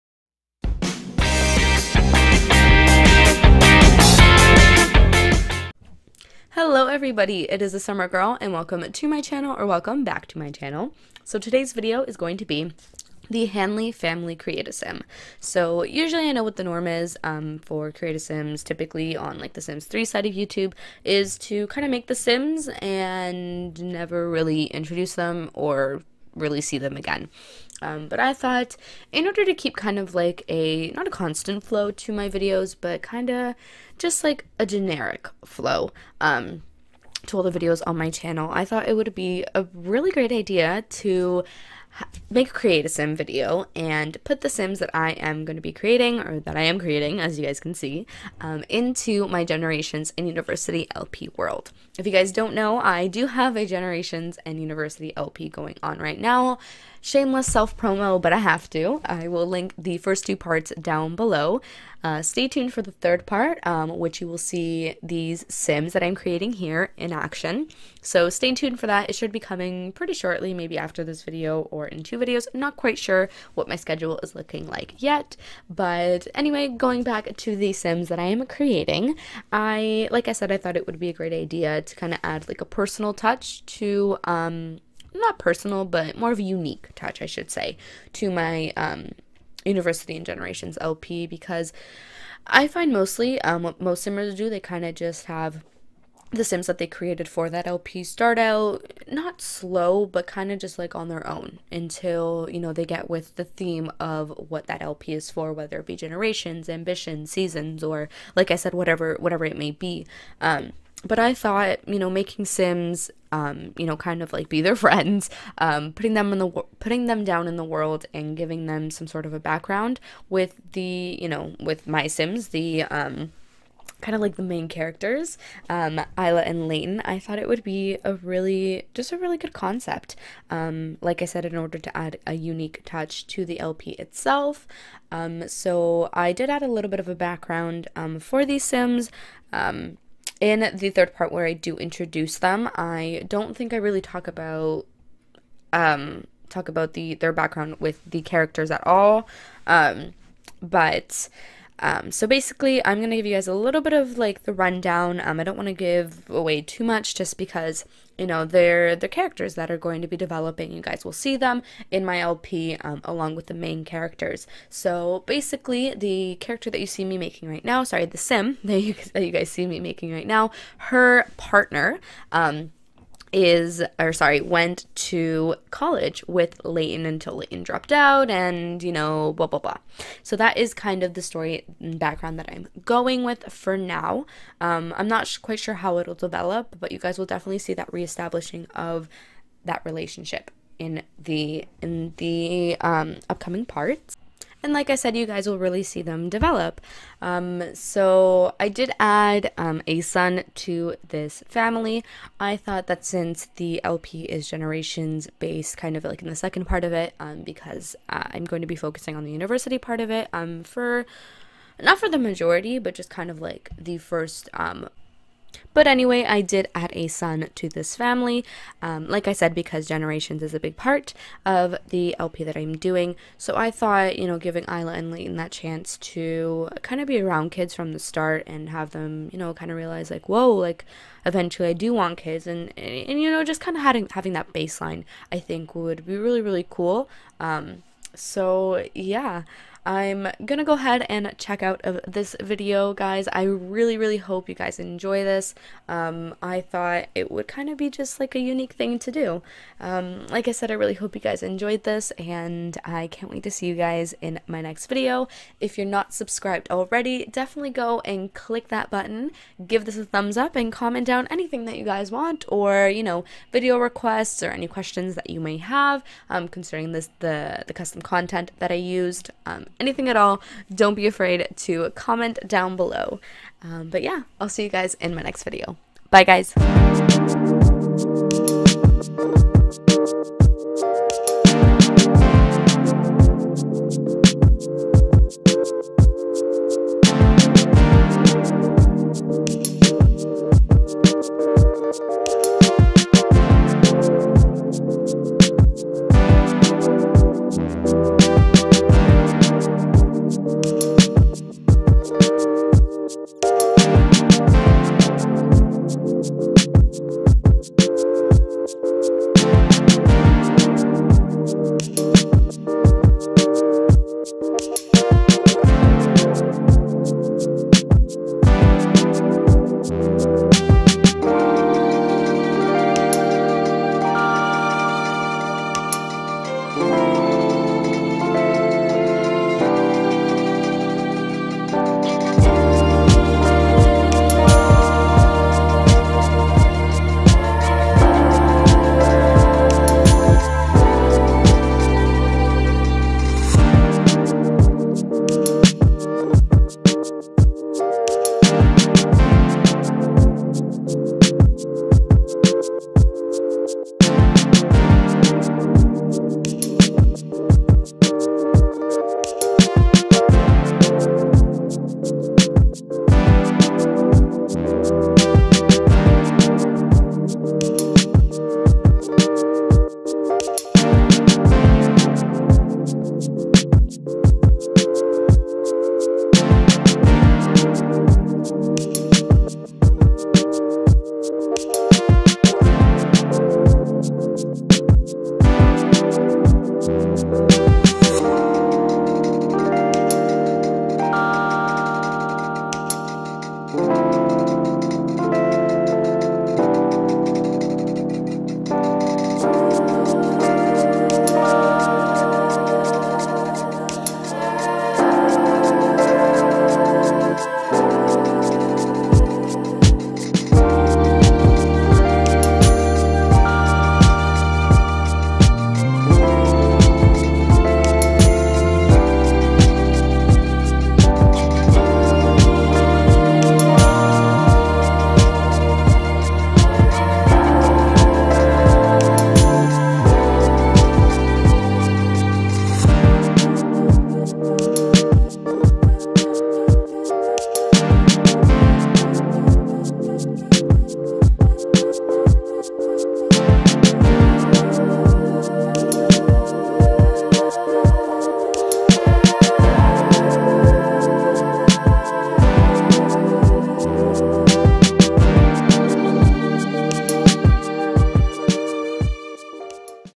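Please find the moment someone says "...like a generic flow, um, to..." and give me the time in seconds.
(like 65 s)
34 s.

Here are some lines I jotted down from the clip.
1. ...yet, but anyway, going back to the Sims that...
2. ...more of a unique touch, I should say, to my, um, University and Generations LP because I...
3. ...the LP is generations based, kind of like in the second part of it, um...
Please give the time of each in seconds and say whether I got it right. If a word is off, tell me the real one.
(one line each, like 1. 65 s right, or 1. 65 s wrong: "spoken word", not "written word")
1. 74 s right
2. 86 s right
3. 203 s right.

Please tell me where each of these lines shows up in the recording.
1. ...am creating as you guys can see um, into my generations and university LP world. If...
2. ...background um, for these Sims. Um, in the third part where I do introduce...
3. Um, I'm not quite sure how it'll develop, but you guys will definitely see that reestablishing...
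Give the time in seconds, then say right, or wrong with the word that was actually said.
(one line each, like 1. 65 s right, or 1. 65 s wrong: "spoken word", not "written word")
1. 46 s right
2. 137 s right
3. 184 s right.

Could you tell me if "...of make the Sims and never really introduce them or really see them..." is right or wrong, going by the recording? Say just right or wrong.
right.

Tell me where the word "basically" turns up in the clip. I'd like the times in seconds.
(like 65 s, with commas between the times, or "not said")
152 s, 165 s.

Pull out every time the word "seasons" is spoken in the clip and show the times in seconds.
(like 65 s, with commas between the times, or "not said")
107 s.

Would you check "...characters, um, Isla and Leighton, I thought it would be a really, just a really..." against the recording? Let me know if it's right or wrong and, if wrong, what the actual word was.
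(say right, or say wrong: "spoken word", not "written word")
right.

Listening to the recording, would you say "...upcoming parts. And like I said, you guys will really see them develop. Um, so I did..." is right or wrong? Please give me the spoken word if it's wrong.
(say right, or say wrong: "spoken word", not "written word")
right.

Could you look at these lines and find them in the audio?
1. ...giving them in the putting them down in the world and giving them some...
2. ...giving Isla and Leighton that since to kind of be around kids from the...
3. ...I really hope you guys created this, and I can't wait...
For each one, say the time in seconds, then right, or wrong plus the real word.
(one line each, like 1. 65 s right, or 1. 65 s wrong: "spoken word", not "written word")
1. 115 s wrong: "putting", not "giving"
2. 224 s wrong: "chance", not "since"
3. 250 s wrong: "enjoyed", not "created".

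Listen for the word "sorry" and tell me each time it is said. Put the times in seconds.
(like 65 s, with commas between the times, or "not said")
167 s, 174 s.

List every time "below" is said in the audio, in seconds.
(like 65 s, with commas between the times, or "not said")
61 s, 272 s.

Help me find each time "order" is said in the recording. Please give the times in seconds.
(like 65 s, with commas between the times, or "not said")
29 s, 131 s.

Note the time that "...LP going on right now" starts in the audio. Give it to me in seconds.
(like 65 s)
55 s.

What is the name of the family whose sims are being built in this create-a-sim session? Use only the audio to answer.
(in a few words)
Hanley.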